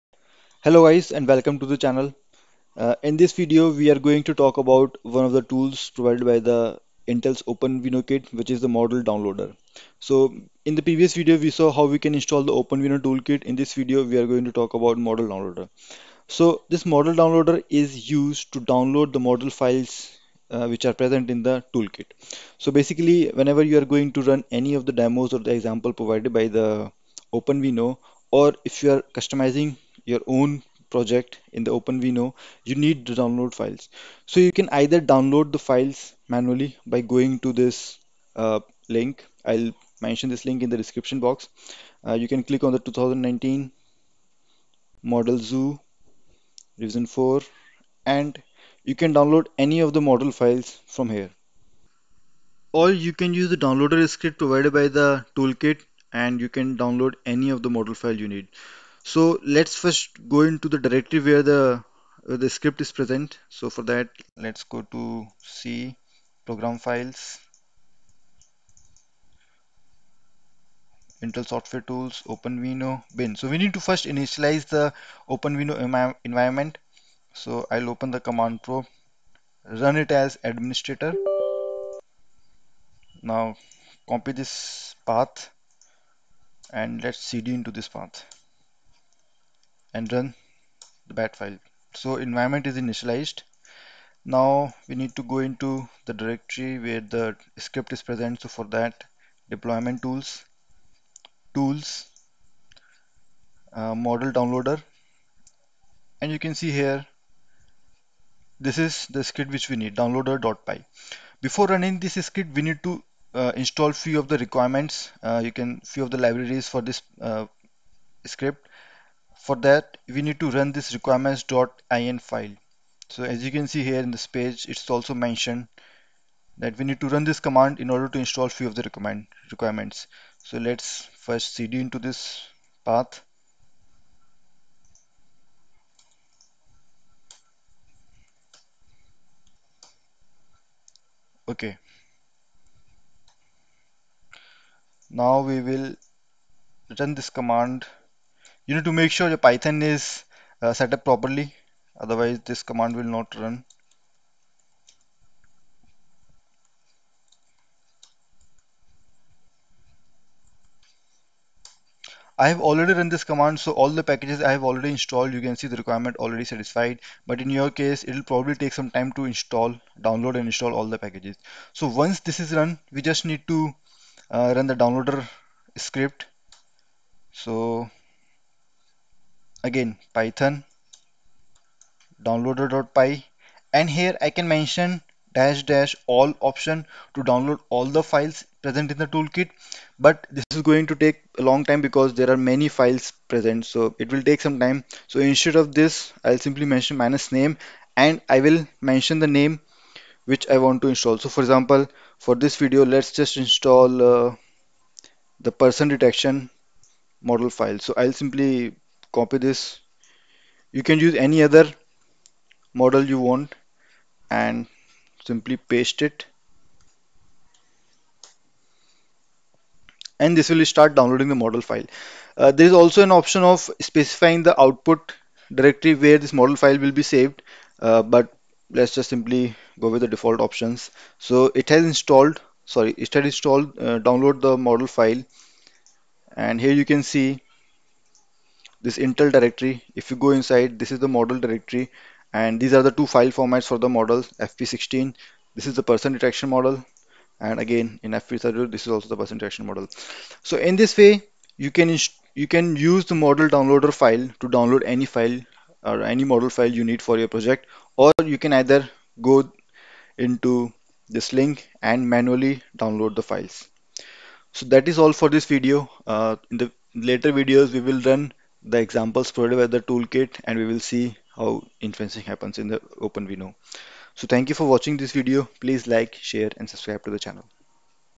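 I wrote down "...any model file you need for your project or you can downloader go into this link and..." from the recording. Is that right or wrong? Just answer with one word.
wrong.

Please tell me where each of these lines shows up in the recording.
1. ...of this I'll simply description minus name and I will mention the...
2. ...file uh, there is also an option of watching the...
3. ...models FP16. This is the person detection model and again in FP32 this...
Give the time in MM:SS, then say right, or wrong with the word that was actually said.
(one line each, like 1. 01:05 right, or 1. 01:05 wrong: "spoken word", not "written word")
1. 03:15 wrong: "mention", not "description"
2. 03:41 wrong: "specifying", not "watching"
3. 04:03 right.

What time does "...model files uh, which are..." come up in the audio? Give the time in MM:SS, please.
00:19.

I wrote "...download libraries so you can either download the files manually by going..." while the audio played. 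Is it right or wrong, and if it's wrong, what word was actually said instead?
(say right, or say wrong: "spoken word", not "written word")
wrong: "files", not "libraries".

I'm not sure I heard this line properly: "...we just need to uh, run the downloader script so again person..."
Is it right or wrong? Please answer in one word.
wrong.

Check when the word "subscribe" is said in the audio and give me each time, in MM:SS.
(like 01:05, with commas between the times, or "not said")
04:36.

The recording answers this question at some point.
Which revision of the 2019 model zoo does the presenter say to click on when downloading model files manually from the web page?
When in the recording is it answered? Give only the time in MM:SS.
00:46.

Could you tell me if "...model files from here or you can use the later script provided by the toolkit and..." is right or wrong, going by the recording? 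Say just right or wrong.
wrong.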